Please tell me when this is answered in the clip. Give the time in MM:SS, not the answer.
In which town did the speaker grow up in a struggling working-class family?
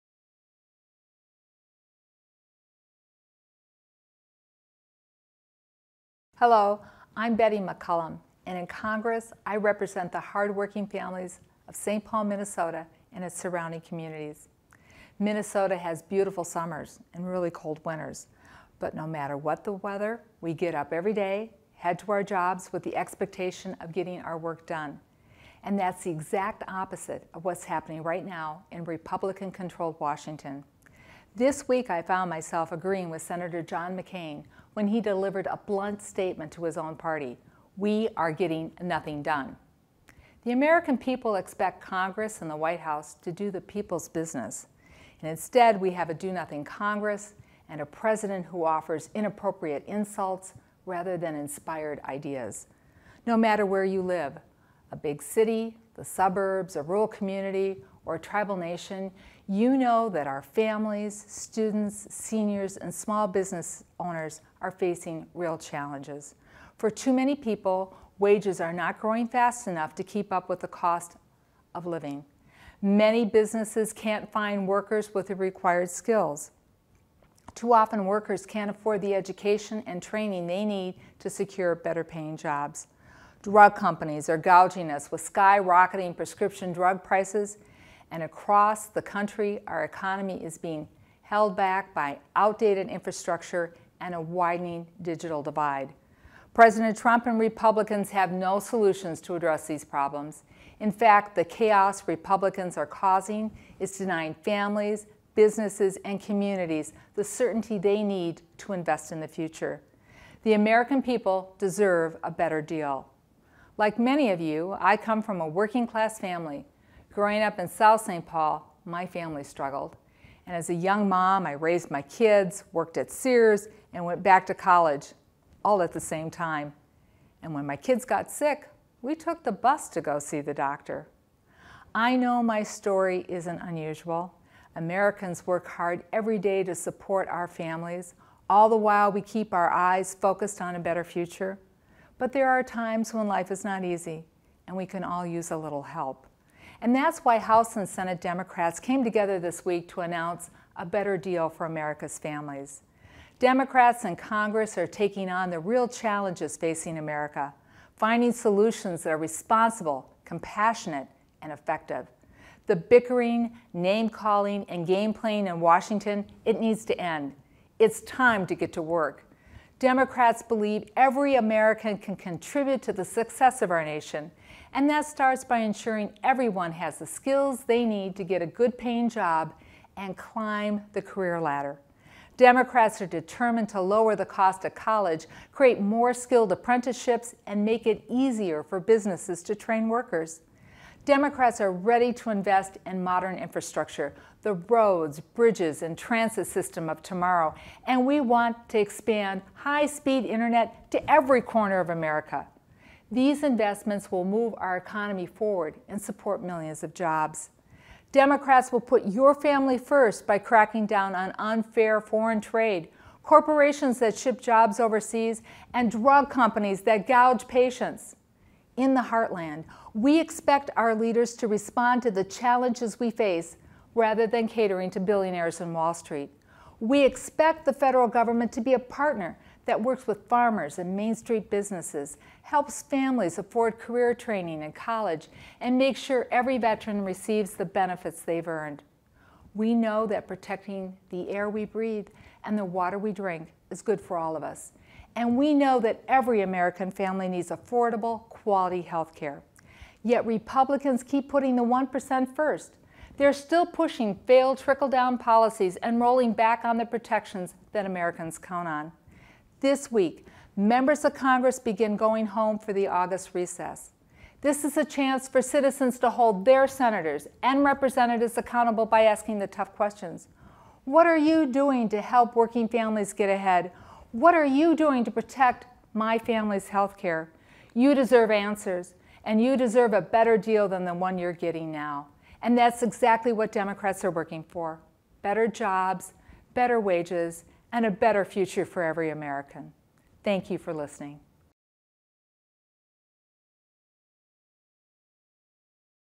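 01:57.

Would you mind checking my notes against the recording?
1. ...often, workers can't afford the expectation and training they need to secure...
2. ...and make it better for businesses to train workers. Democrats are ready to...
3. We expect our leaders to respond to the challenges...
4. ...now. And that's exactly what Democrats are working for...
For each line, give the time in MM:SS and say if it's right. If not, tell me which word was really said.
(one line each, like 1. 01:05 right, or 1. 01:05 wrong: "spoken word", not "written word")
1. 01:17 wrong: "education", not "expectation"
2. 03:07 wrong: "easier", not "better"
3. 03:39 right
4. 04:41 right.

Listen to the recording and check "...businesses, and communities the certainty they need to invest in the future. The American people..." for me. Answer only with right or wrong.
right.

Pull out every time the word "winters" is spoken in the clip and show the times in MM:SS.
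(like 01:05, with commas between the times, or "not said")
00:17.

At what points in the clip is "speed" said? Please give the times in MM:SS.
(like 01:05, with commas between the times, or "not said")
03:19.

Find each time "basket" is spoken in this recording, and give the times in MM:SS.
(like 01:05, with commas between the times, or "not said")
not said.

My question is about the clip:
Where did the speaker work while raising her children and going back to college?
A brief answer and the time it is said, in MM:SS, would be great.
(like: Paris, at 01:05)
Sears, at 02:03.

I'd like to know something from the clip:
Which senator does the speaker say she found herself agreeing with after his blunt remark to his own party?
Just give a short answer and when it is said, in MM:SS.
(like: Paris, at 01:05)
John McCain, at 00:33.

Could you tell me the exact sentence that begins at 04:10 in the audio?
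Yet Republicans keep putting the 1% first.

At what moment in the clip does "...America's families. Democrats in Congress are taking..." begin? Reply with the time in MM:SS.
02:31.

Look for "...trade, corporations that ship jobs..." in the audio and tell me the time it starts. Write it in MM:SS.
03:32.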